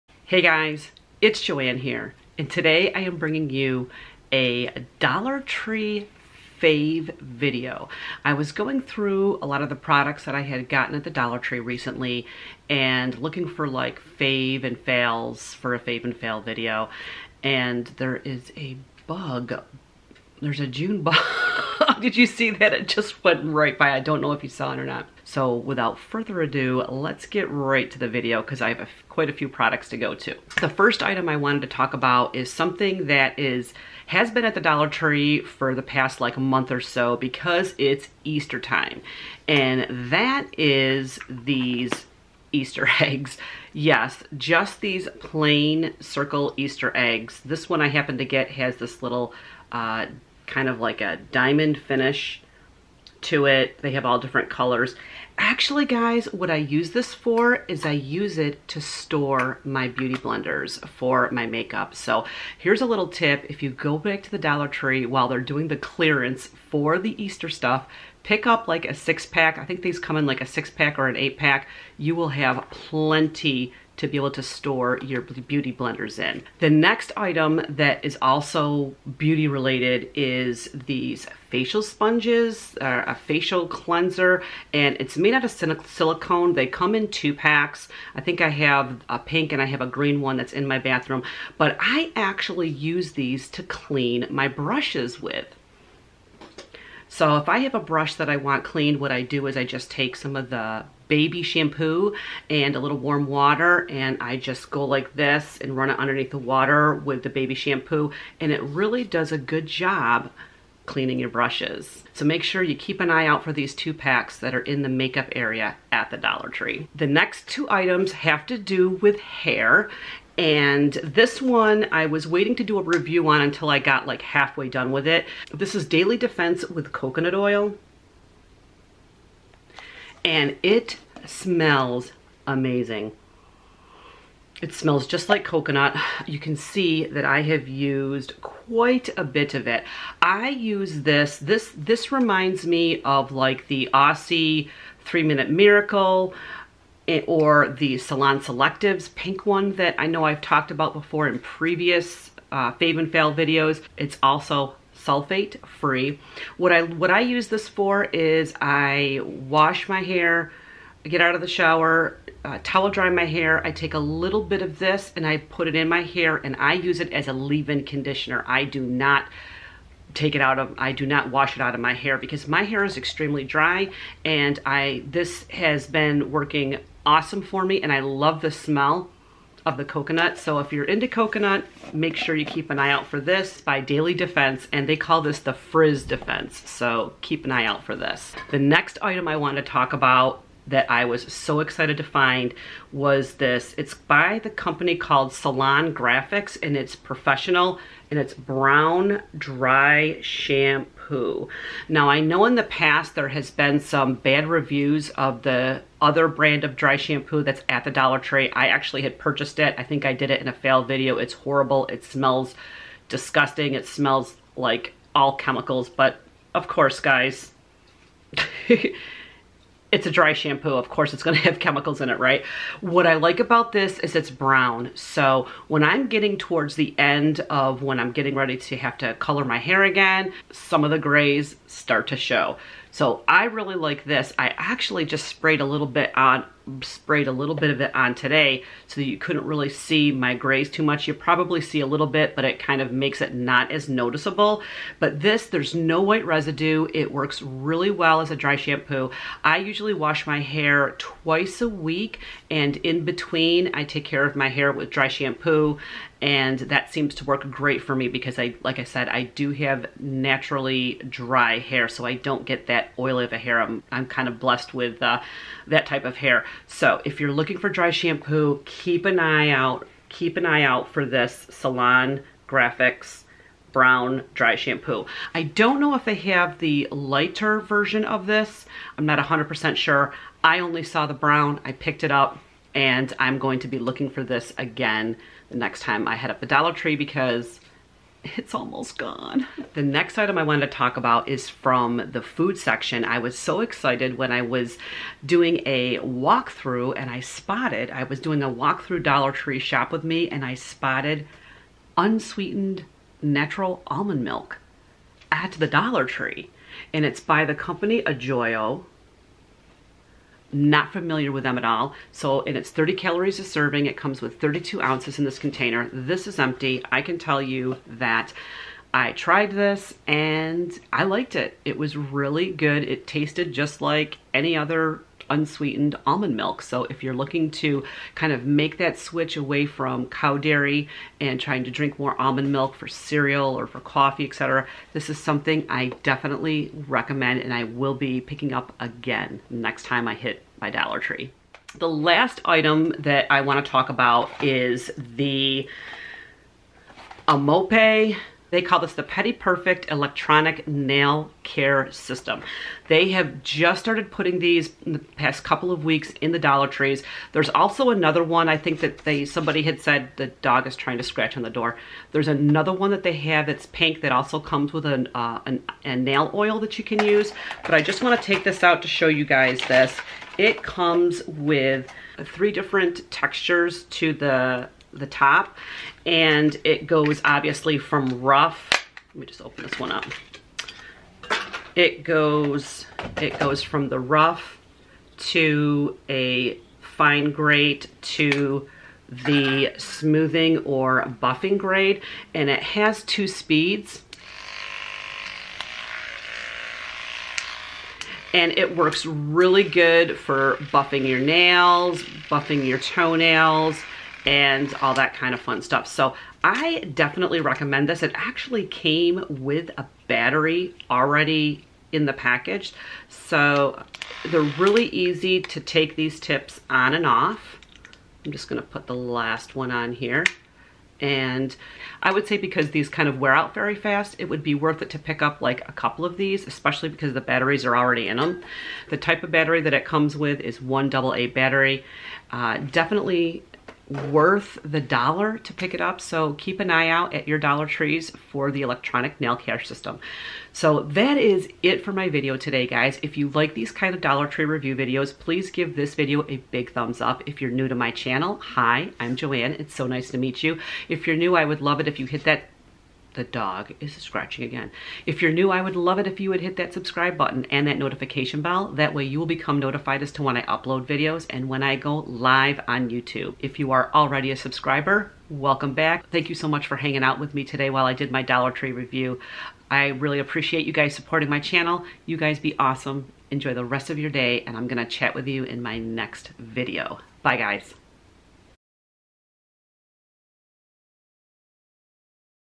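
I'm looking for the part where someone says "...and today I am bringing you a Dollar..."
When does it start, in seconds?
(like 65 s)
2 s.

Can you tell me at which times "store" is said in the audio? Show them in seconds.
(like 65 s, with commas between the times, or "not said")
58 s, 74 s.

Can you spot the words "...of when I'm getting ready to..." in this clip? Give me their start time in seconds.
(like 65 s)
227 s.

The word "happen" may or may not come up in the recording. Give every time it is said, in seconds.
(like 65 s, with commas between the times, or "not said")
47 s.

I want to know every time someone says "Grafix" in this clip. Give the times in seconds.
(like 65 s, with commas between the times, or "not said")
195 s, 272 s.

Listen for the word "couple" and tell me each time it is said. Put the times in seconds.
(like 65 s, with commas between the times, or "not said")
355 s, 425 s.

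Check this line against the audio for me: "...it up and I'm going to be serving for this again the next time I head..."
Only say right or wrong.
wrong.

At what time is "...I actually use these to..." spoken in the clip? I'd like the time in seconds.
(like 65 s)
91 s.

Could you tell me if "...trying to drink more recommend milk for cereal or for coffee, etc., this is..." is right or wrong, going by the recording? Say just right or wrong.
wrong.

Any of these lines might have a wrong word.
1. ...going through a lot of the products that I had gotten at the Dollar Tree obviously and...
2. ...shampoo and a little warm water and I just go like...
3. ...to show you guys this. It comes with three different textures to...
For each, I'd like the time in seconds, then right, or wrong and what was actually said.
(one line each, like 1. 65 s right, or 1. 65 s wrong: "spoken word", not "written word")
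1. 8 s wrong: "recently", not "obviously"
2. 101 s right
3. 368 s right.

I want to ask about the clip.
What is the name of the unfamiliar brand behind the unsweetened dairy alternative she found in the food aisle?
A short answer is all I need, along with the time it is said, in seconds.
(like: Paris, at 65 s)
Ajoyo, at 308 s.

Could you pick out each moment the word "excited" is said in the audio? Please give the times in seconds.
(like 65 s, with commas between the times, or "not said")
191 s, 293 s.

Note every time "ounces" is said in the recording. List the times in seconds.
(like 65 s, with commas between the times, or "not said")
314 s.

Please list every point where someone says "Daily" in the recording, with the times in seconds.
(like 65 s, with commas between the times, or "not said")
125 s, 183 s.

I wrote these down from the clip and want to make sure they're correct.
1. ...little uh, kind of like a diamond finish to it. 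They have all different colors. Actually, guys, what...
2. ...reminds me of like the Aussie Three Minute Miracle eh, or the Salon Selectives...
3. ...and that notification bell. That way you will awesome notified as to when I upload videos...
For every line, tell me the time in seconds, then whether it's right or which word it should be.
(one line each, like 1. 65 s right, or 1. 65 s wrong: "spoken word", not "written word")
1. 49 s right
2. 142 s right
3. 457 s wrong: "become", not "awesome".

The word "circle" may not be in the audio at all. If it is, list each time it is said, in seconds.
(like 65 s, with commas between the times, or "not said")
46 s.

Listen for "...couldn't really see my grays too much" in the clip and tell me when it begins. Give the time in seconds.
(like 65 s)
239 s.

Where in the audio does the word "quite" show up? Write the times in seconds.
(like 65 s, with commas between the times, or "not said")
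29 s, 138 s.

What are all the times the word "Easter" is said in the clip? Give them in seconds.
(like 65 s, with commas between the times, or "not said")
38 s, 42 s, 46 s, 67 s.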